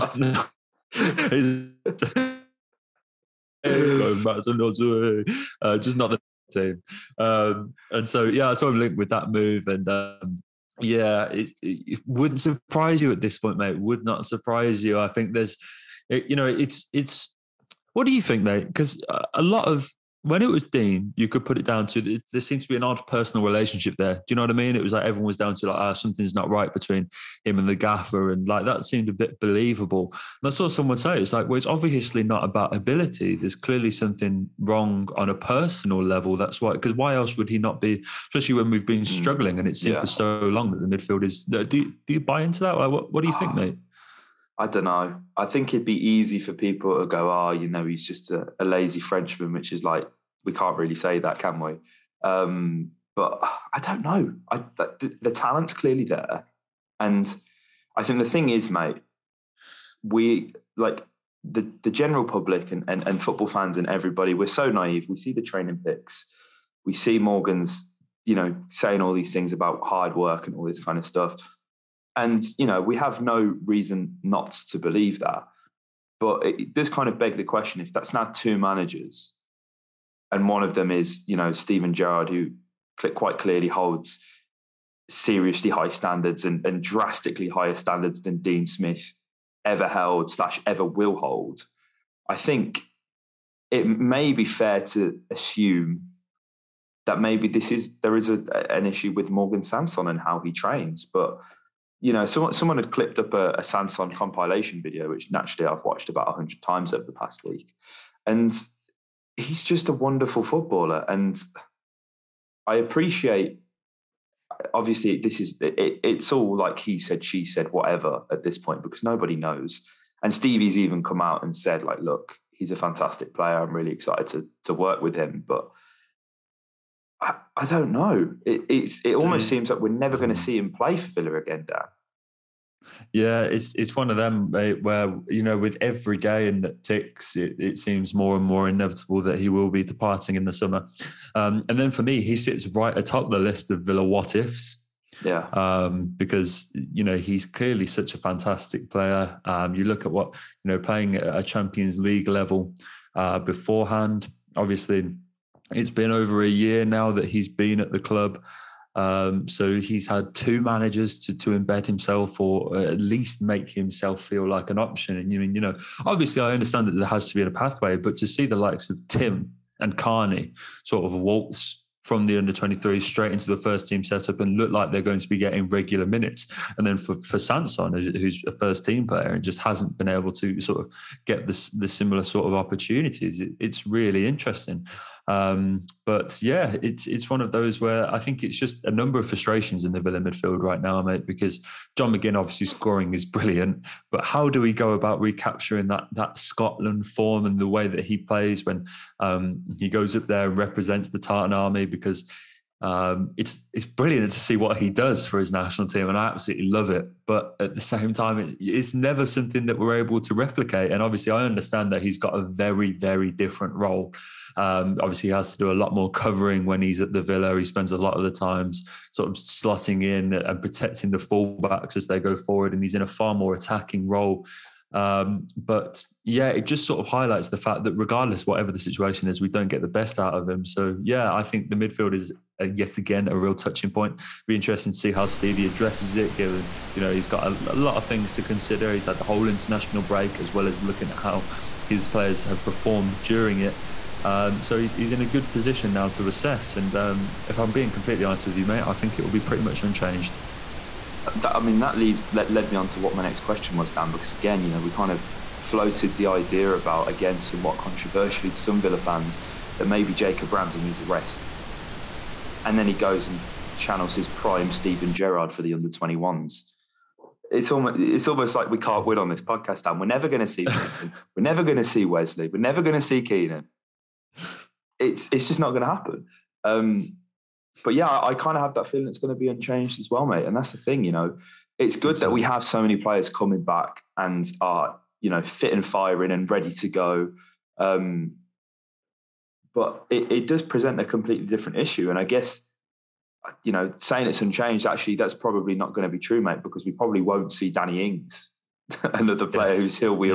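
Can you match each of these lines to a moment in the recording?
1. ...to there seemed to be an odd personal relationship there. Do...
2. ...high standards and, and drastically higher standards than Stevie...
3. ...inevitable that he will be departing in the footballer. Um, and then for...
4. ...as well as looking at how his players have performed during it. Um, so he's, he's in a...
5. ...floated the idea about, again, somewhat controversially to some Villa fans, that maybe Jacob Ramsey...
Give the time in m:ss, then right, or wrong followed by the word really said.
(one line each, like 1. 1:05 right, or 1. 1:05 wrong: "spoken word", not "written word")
1. 0:21 right
2. 1:25 wrong: "Dean", not "Stevie"
3. 2:18 wrong: "summer", not "footballer"
4. 4:00 right
5. 4:15 right.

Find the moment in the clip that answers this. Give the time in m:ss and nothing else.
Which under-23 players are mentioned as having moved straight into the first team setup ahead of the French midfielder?
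2:49.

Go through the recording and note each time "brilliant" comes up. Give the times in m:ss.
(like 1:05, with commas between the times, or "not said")
3:13, 3:23.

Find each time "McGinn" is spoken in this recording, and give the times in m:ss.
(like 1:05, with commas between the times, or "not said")
3:12.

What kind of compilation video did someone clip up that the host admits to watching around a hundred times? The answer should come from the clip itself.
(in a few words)
Sanson compilation.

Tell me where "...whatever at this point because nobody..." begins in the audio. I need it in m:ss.
1:57.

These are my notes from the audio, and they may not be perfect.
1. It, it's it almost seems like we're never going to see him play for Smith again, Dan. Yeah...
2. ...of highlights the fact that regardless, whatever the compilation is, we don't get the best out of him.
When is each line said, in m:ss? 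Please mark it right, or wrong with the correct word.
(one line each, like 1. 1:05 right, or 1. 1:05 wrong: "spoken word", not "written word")
1. 2:08 wrong: "Villa", not "Smith"
2. 3:47 wrong: "situation", not "compilation".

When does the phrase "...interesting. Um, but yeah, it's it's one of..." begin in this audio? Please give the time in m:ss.
3:04.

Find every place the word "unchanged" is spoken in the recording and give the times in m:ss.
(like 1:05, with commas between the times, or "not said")
4:09, 4:39, 4:54.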